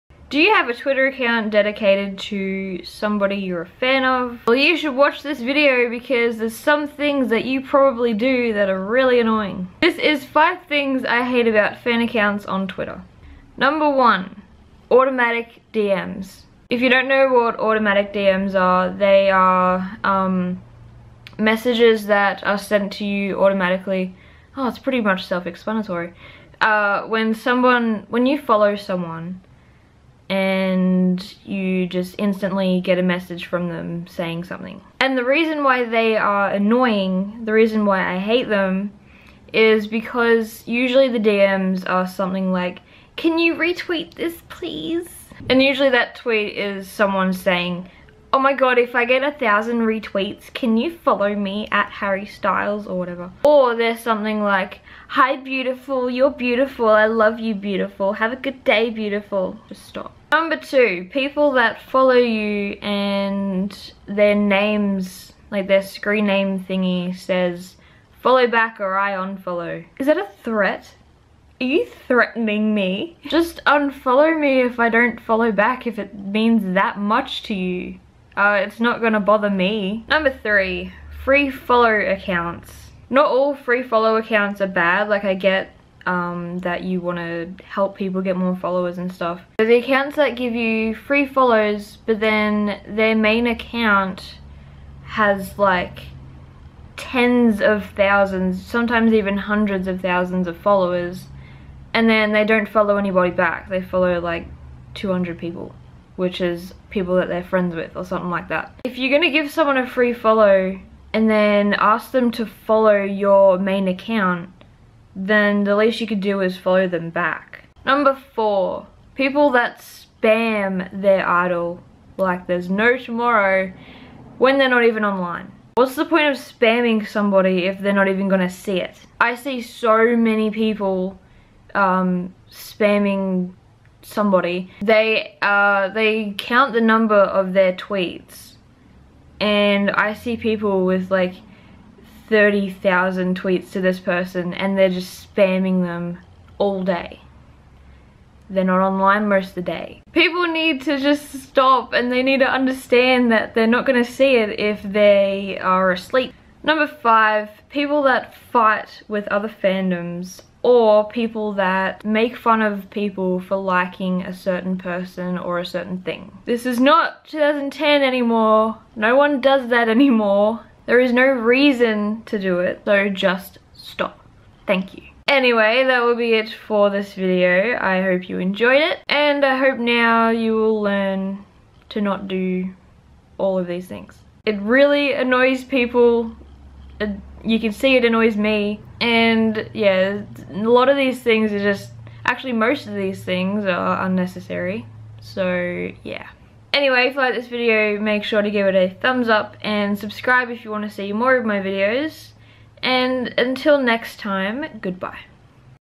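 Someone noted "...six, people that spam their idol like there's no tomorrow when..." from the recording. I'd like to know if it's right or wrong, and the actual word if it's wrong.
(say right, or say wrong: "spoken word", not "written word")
wrong: "four", not "six".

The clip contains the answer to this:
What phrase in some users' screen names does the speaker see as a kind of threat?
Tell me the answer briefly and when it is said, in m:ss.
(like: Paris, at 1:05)
follow back or I unfollow, at 1:08.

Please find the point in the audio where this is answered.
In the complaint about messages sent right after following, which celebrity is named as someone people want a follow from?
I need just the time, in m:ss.
0:51.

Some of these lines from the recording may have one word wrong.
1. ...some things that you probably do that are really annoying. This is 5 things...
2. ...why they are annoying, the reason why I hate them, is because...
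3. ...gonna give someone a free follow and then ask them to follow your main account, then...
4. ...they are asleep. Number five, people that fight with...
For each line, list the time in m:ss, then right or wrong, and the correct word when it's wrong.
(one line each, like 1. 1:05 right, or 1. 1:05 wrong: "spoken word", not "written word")
1. 0:06 right
2. 0:35 right
3. 1:49 right
4. 2:34 right.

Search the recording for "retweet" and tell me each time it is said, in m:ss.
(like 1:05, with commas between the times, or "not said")
0:43, 0:49.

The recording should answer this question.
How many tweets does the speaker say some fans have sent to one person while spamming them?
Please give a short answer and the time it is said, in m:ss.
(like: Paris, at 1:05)
30,000, at 2:22.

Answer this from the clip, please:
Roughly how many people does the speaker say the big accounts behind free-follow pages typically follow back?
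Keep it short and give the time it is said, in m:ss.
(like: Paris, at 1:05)
200, at 1:44.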